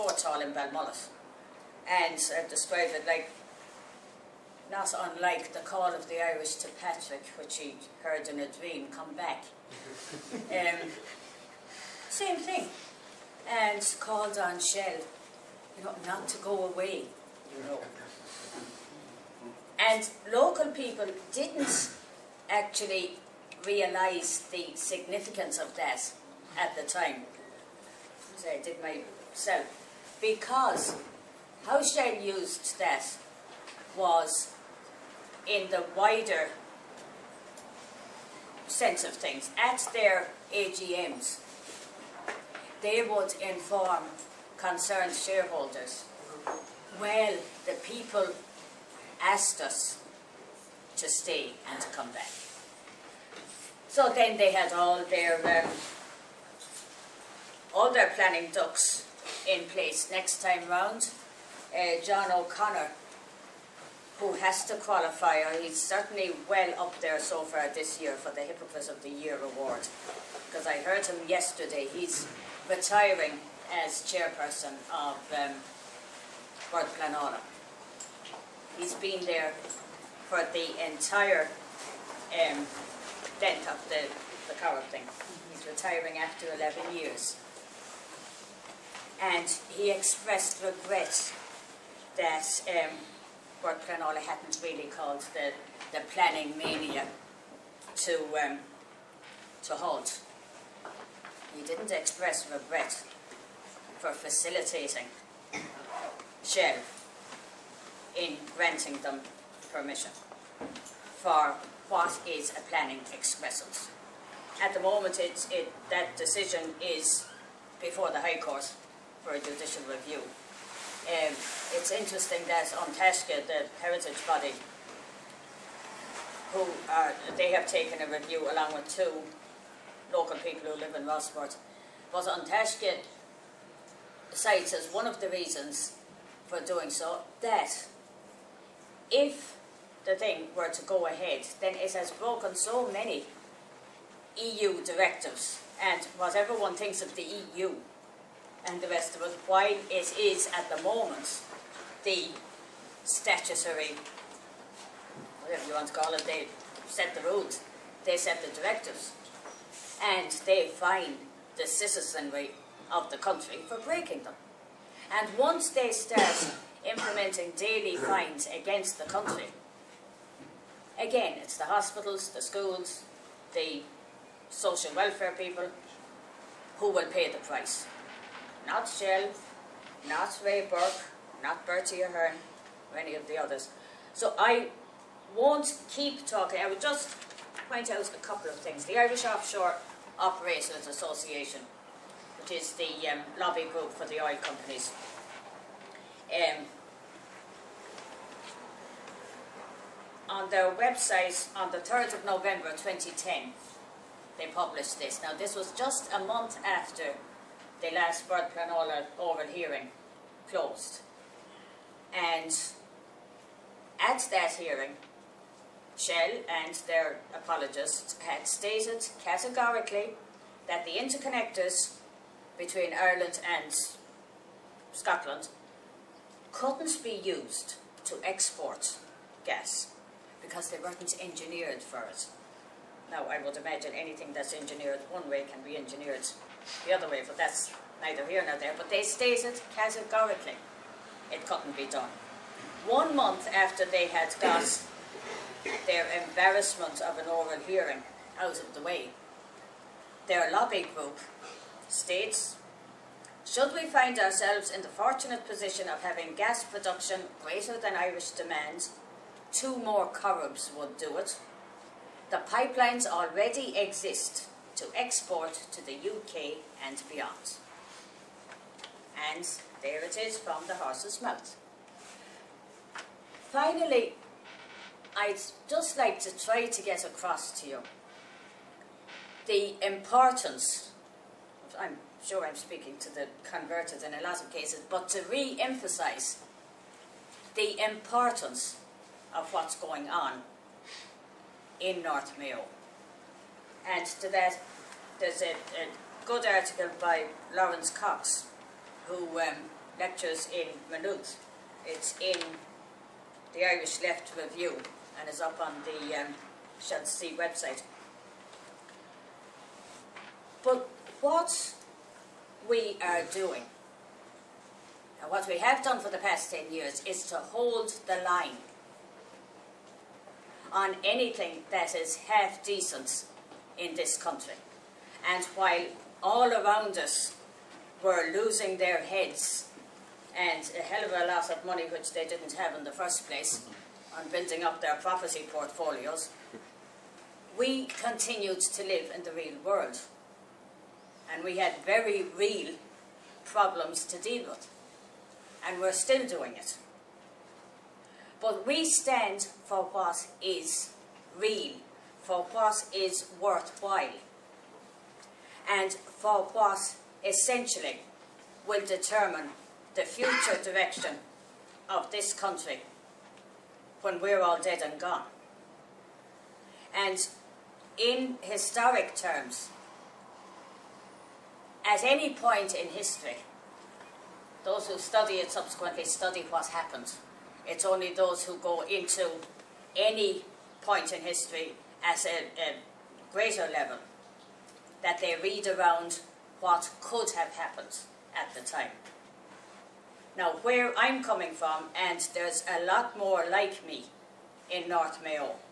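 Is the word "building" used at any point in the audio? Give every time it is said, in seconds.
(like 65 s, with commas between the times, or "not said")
334 s.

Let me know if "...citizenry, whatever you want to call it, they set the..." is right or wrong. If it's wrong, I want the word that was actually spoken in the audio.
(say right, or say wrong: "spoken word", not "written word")
wrong: "statutory", not "citizenry".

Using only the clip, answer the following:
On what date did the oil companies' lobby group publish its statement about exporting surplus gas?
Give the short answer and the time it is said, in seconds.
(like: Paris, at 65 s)
3 November 2010, at 201 s.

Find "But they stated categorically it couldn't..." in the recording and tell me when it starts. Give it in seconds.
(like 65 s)
238 s.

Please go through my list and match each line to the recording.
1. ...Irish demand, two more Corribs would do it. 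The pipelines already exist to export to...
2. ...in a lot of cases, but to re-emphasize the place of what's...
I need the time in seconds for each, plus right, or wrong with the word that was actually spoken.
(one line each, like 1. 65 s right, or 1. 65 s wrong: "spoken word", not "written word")
1. 257 s right
2. 284 s wrong: "importance", not "place".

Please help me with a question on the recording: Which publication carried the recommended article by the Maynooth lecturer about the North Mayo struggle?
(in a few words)
Irish Left Review.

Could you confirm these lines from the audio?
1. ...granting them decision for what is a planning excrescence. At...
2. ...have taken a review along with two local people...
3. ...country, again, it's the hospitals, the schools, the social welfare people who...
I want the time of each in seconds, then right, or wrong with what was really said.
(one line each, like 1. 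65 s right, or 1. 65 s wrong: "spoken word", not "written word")
1. 108 s wrong: "permission", not "decision"
2. 127 s right
3. 169 s right.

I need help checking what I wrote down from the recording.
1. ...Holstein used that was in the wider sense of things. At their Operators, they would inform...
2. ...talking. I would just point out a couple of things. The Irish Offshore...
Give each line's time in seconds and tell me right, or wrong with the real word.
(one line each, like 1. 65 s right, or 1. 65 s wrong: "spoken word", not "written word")
1. 31 s wrong: "AGMs", not "Operators"
2. 186 s right.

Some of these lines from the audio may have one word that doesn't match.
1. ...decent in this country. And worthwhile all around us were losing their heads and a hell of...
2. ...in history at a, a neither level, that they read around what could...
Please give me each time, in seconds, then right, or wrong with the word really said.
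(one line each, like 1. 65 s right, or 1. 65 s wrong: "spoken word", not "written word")
1. 322 s wrong: "while", not "worthwhile"
2. 381 s wrong: "greater", not "neither".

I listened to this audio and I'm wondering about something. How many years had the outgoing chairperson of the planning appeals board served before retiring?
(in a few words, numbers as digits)
11.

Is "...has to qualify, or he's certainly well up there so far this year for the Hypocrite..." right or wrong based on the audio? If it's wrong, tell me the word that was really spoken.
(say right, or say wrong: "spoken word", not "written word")
right.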